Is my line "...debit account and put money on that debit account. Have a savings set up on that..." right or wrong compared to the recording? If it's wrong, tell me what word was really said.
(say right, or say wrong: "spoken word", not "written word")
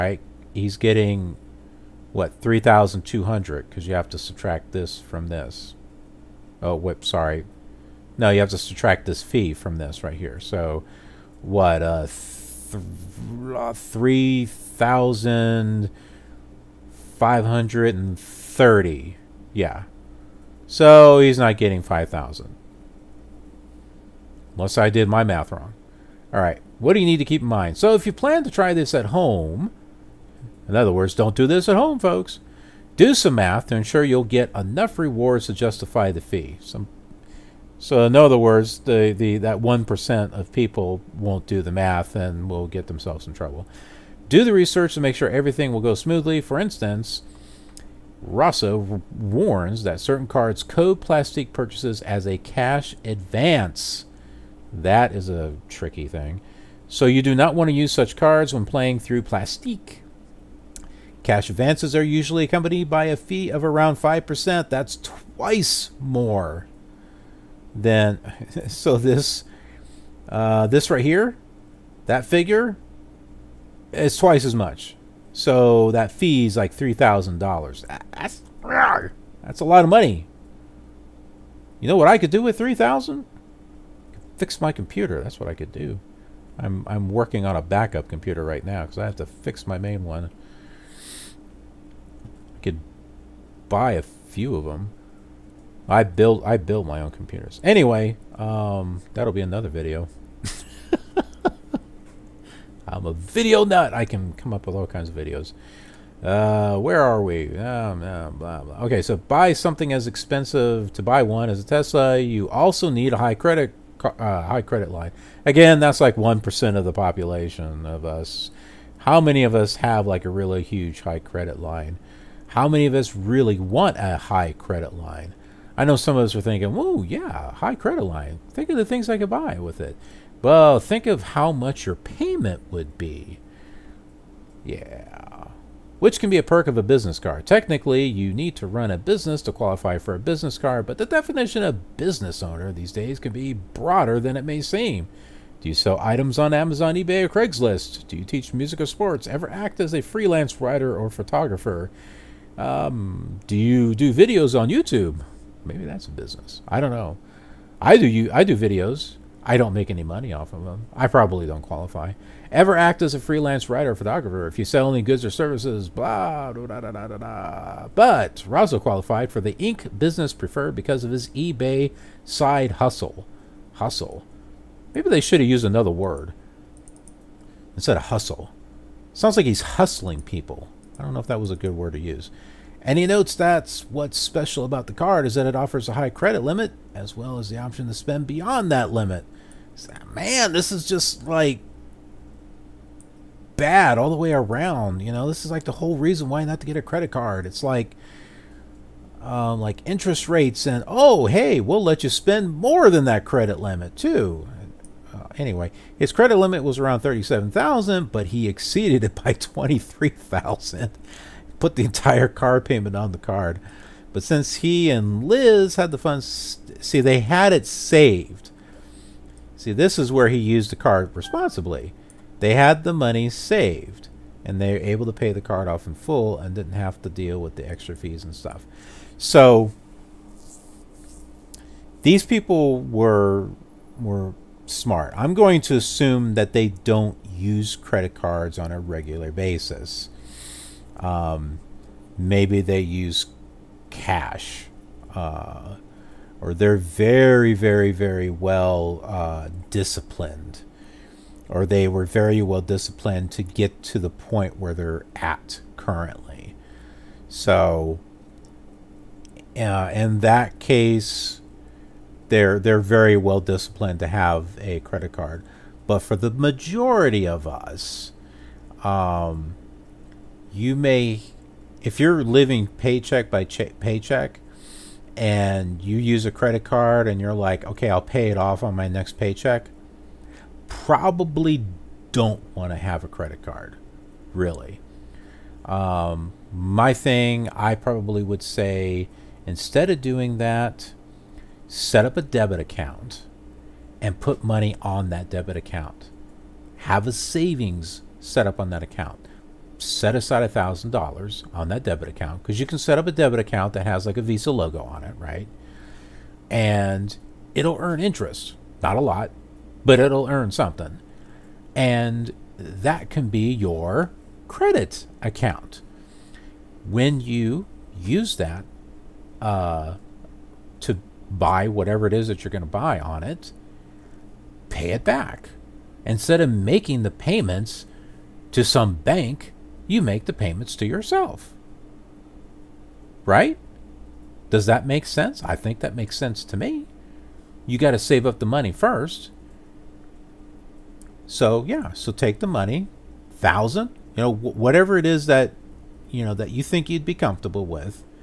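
right.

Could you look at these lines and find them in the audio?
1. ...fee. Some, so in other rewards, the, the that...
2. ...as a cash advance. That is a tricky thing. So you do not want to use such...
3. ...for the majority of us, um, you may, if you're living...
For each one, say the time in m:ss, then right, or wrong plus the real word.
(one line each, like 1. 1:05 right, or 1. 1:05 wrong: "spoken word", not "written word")
1. 0:36 wrong: "words", not "rewards"
2. 0:52 right
3. 4:26 right.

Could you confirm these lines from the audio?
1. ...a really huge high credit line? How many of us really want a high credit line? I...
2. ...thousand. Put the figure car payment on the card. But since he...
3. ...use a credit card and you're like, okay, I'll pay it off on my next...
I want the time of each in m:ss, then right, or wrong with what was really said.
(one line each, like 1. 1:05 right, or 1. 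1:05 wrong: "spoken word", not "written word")
1. 2:00 right
2. 3:30 wrong: "entire", not "figure"
3. 4:35 right.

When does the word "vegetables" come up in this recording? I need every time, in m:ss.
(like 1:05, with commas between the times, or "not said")
not said.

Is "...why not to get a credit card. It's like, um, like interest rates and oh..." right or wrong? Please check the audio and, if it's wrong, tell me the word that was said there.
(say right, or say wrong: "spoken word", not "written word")
right.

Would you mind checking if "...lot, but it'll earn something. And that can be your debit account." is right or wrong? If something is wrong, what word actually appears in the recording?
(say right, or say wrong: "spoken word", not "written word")
wrong: "credit", not "debit".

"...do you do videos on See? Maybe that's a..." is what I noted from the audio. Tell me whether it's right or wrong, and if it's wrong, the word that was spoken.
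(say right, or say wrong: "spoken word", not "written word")
wrong: "YouTube", not "See".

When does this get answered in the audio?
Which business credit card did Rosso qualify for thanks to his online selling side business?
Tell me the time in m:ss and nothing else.
2:49.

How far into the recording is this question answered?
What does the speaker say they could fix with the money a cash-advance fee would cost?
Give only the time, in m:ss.
1:24.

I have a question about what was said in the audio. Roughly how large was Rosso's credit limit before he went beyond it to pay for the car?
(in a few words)
$37,000.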